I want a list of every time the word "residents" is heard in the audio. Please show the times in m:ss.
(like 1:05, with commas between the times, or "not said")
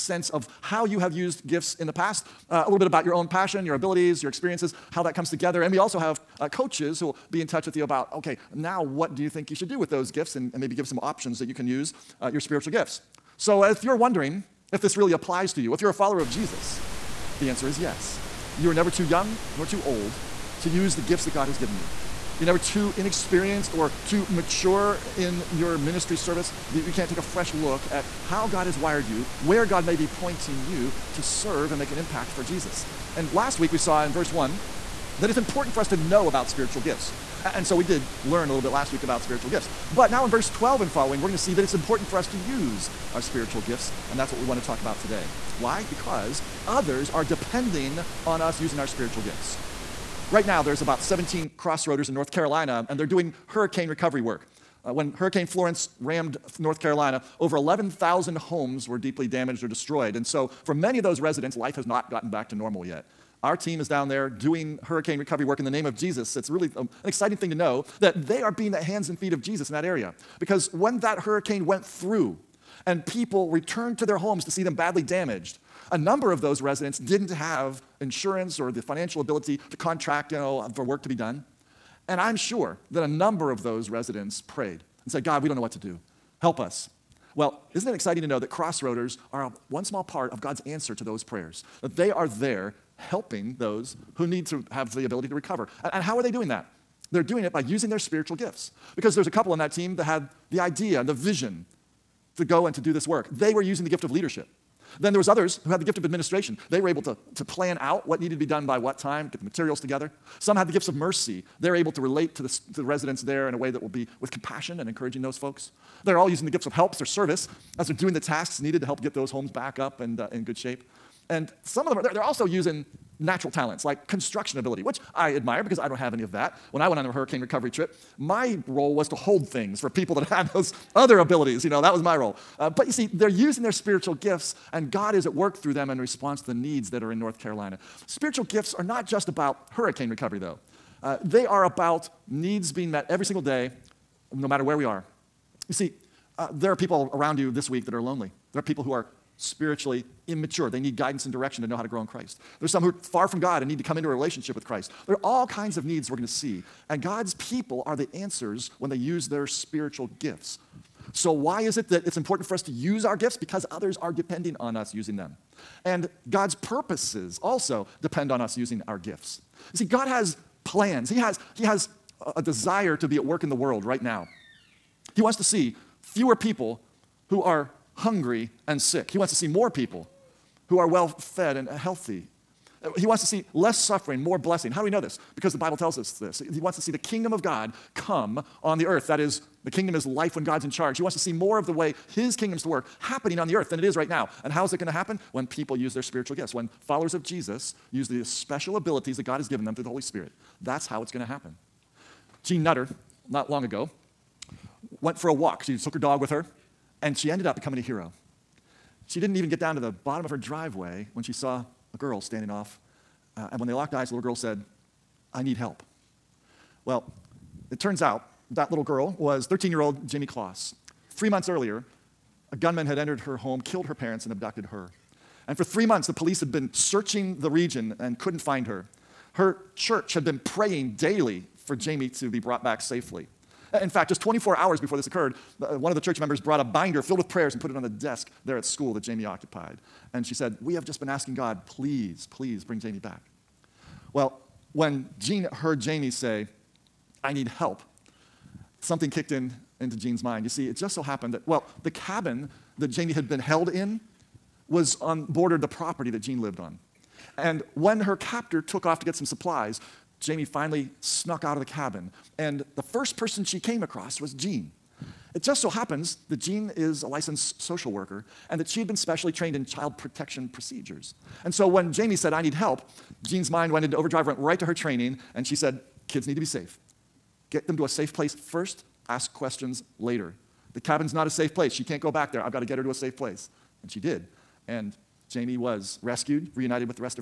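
1:01, 1:16, 1:23, 1:52.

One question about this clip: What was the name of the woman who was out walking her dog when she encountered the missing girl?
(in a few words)
Jeanne Nutter.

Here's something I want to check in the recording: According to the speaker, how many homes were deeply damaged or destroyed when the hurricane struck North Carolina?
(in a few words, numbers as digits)
11,000.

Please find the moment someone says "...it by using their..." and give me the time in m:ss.
1:37.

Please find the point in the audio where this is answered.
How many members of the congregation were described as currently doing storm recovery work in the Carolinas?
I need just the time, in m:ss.
0:51.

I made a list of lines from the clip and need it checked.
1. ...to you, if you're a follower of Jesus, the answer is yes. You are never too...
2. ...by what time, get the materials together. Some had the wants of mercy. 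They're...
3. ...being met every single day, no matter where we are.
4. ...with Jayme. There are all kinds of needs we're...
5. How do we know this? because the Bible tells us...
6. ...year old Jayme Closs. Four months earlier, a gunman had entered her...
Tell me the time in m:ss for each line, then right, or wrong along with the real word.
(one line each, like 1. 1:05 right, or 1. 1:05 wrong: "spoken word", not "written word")
1. 0:15 right
2. 1:48 wrong: "gifts", not "wants"
3. 2:22 right
4. 2:34 wrong: "Christ", not "Jayme"
5. 3:04 right
6. 3:39 wrong: "Three", not "Four".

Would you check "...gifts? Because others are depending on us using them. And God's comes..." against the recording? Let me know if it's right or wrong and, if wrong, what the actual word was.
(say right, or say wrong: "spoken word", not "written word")
wrong: "purposes", not "comes".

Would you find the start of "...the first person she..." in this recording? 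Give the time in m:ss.
4:22.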